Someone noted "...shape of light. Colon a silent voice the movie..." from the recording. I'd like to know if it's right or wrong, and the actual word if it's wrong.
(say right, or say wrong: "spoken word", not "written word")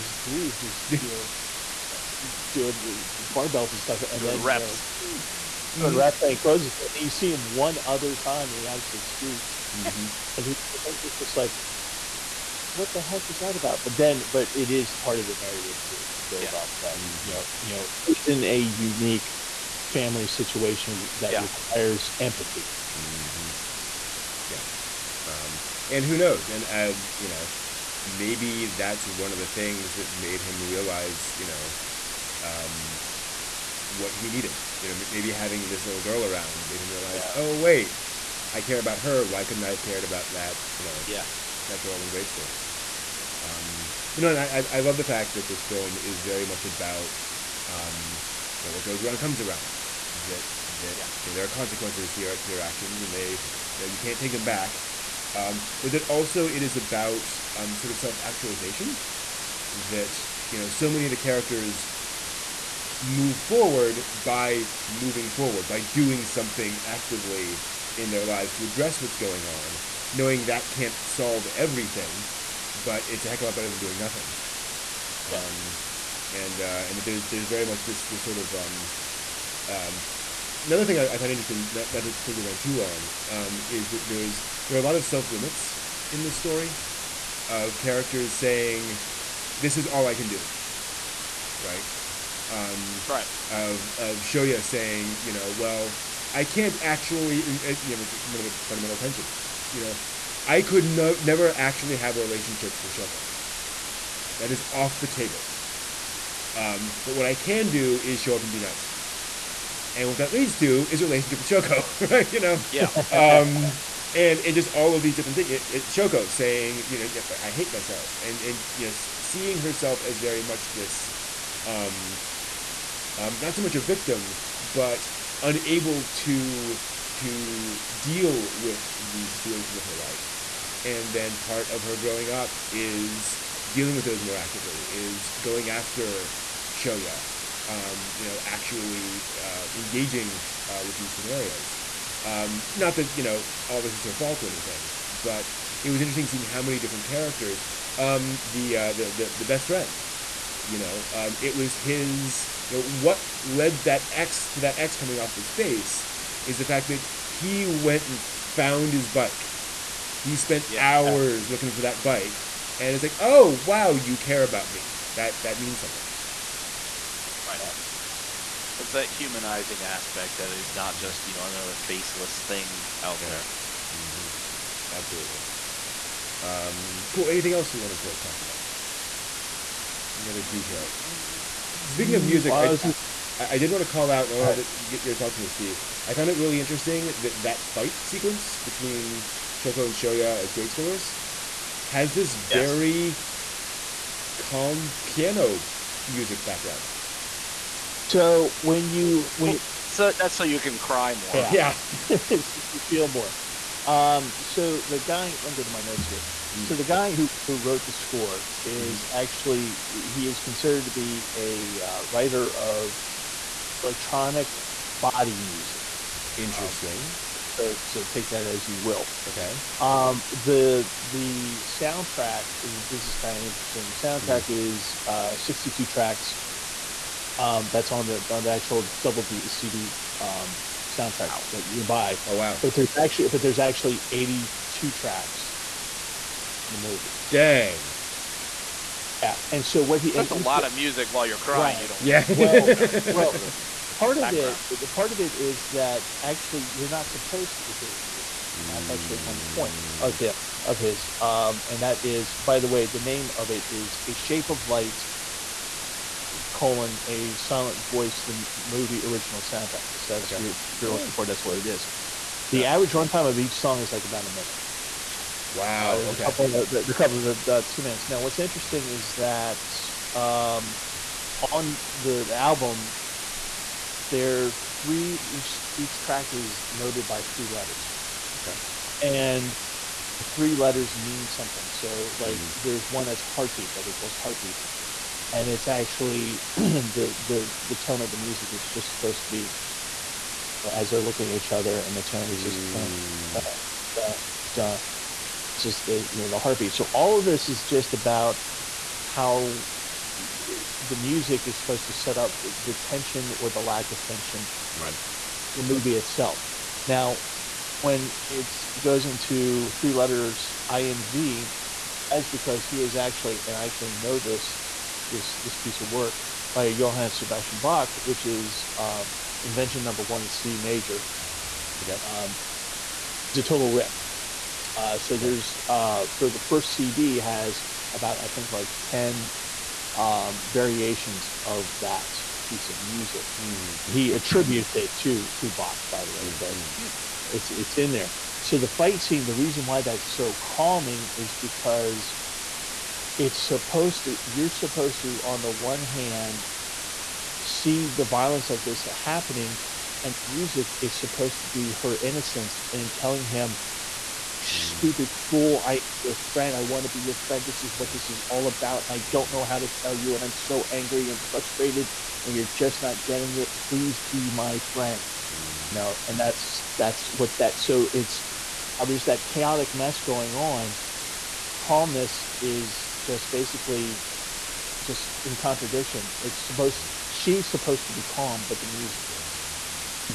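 right.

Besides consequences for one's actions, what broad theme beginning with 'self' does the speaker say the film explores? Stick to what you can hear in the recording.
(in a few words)
self actualization.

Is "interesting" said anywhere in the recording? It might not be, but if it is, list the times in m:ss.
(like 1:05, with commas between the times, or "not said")
1:21, 2:26, 3:06, 3:36, 3:43, 4:28.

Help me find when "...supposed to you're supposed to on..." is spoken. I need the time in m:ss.
5:43.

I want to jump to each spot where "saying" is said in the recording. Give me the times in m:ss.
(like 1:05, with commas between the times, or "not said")
1:28, 1:34, 1:56.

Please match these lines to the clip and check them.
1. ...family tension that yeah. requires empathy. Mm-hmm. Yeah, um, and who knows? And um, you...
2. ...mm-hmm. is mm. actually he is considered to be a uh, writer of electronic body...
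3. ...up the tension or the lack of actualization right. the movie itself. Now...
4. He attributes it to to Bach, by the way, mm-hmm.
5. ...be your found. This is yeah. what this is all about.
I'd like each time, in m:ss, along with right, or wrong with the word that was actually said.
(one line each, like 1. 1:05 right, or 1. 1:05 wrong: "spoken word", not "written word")
1. 0:19 wrong: "situation", not "tension"
2. 3:28 right
3. 5:02 wrong: "tension", not "actualization"
4. 5:33 right
5. 5:56 wrong: "friend", not "found".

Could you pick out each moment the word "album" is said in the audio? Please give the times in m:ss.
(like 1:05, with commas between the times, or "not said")
4:32.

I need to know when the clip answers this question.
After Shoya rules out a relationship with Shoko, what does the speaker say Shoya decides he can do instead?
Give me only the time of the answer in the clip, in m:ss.
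1:48.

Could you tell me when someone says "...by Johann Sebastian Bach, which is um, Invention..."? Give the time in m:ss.
5:16.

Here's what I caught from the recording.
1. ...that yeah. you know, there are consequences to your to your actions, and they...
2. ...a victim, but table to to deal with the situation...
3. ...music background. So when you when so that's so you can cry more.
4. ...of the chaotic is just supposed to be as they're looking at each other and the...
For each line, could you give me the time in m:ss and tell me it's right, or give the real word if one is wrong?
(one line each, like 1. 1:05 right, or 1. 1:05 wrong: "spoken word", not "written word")
1. 0:50 right
2. 2:03 wrong: "unable", not "table"
3. 3:16 right
4. 4:48 wrong: "music", not "chaotic".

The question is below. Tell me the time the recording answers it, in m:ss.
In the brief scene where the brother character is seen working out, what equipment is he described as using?
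0:03.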